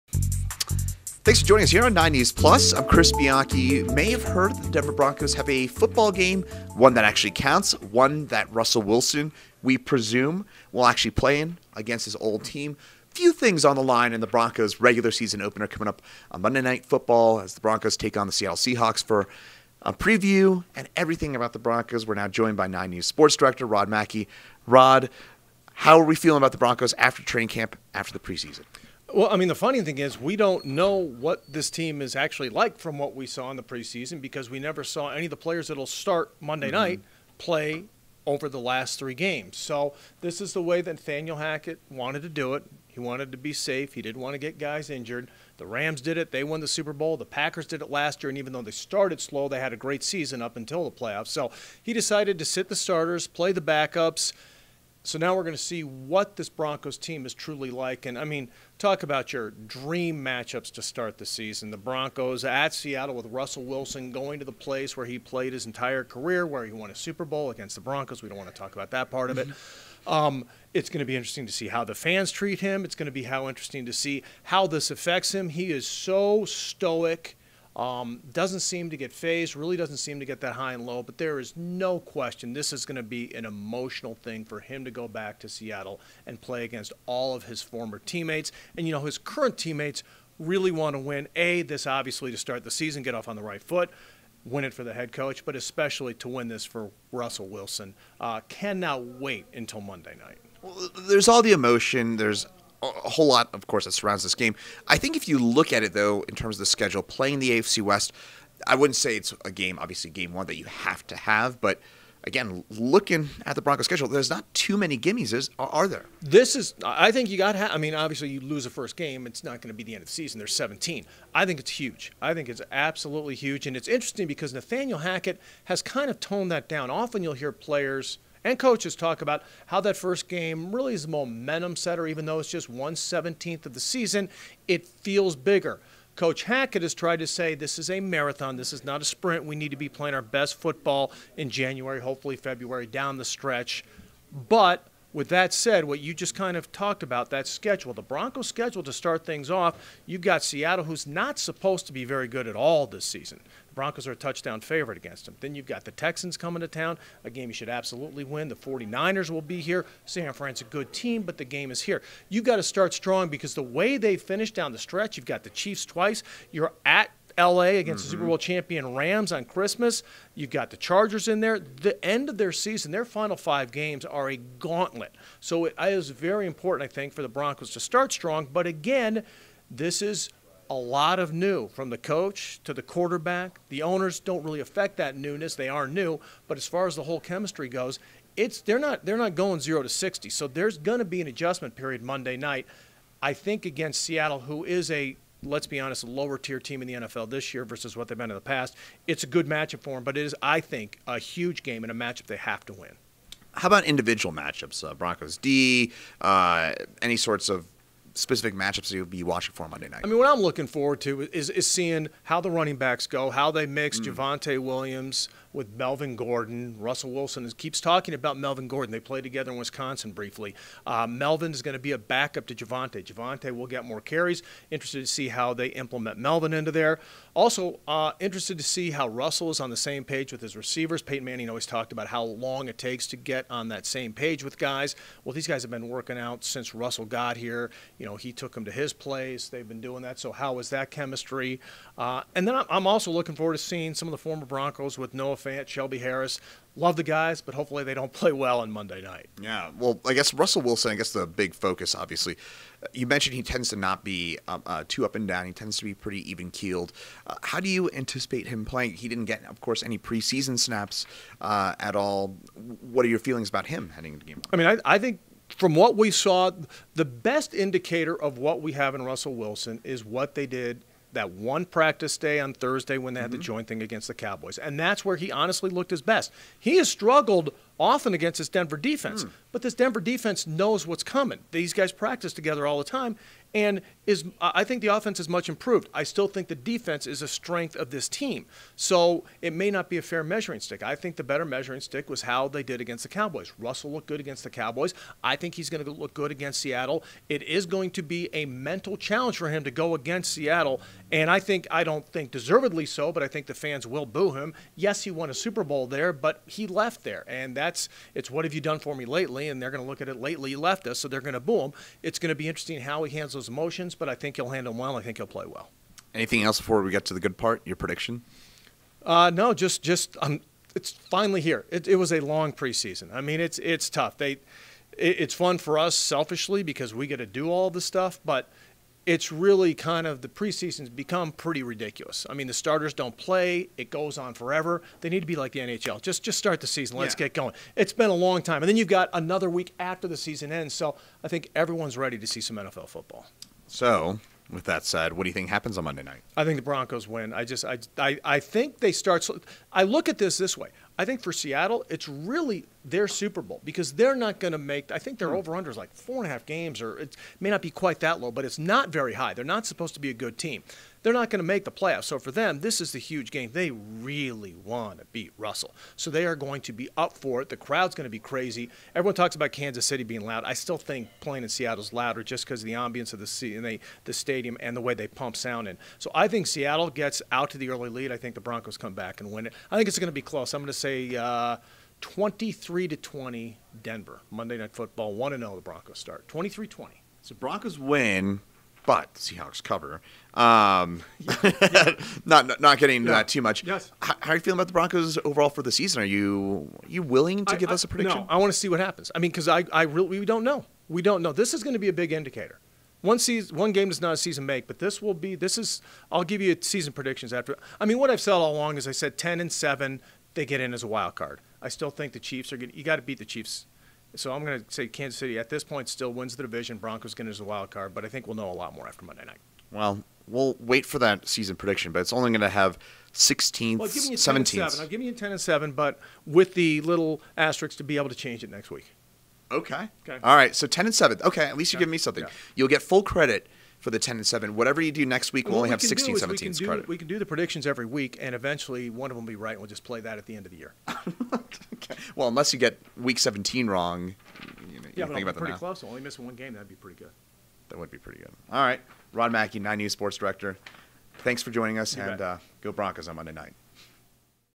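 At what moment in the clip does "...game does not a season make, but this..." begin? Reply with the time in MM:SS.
06:43.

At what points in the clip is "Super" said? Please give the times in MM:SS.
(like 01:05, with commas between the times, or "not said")
00:46, 01:06, 02:48, 05:05, 05:53.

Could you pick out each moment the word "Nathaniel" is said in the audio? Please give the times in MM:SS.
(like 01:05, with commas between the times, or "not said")
00:40, 02:04.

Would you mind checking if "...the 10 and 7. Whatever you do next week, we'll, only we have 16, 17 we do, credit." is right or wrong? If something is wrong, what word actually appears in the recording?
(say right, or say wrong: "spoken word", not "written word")
right.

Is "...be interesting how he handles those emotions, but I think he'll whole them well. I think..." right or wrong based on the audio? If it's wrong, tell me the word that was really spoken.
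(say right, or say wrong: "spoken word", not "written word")
wrong: "handle", not "whole".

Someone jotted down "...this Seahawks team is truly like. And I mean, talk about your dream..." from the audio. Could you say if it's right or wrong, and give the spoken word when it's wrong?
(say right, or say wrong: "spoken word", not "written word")
wrong: "Broncos", not "Seahawks".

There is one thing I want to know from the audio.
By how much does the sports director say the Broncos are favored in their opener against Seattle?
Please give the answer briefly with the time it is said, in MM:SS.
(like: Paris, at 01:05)
A touchdown, at 02:34.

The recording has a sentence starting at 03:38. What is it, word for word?
They played together in Wisconsin briefly.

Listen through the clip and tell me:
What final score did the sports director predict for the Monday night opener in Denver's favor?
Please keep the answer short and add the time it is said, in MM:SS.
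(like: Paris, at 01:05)
23-20, at 06:22.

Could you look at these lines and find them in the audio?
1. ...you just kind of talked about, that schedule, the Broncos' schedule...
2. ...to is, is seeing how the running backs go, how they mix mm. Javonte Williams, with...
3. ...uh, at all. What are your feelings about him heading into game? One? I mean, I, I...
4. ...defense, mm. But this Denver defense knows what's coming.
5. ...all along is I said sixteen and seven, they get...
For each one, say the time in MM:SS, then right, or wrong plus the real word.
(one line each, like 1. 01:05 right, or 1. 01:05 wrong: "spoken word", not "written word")
1. 02:25 right
2. 03:31 right
3. 04:21 right
4. 04:38 right
5. 06:48 wrong: "ten", not "sixteen".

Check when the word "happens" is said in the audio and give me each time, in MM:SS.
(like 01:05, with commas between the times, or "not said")
05:45, 06:38.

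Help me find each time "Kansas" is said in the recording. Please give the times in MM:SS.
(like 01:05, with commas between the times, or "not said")
06:09, 06:54.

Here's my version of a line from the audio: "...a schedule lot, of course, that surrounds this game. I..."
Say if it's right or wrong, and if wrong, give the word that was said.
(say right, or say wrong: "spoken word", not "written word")
wrong: "whole", not "schedule".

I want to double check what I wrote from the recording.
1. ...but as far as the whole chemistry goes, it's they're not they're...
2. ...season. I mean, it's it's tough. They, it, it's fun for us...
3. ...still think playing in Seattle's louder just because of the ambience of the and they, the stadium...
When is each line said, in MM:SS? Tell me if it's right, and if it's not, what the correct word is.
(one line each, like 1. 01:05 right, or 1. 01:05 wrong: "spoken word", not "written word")
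1. 03:06 right
2. 05:22 wrong: "preseason", not "season"
3. 06:10 right.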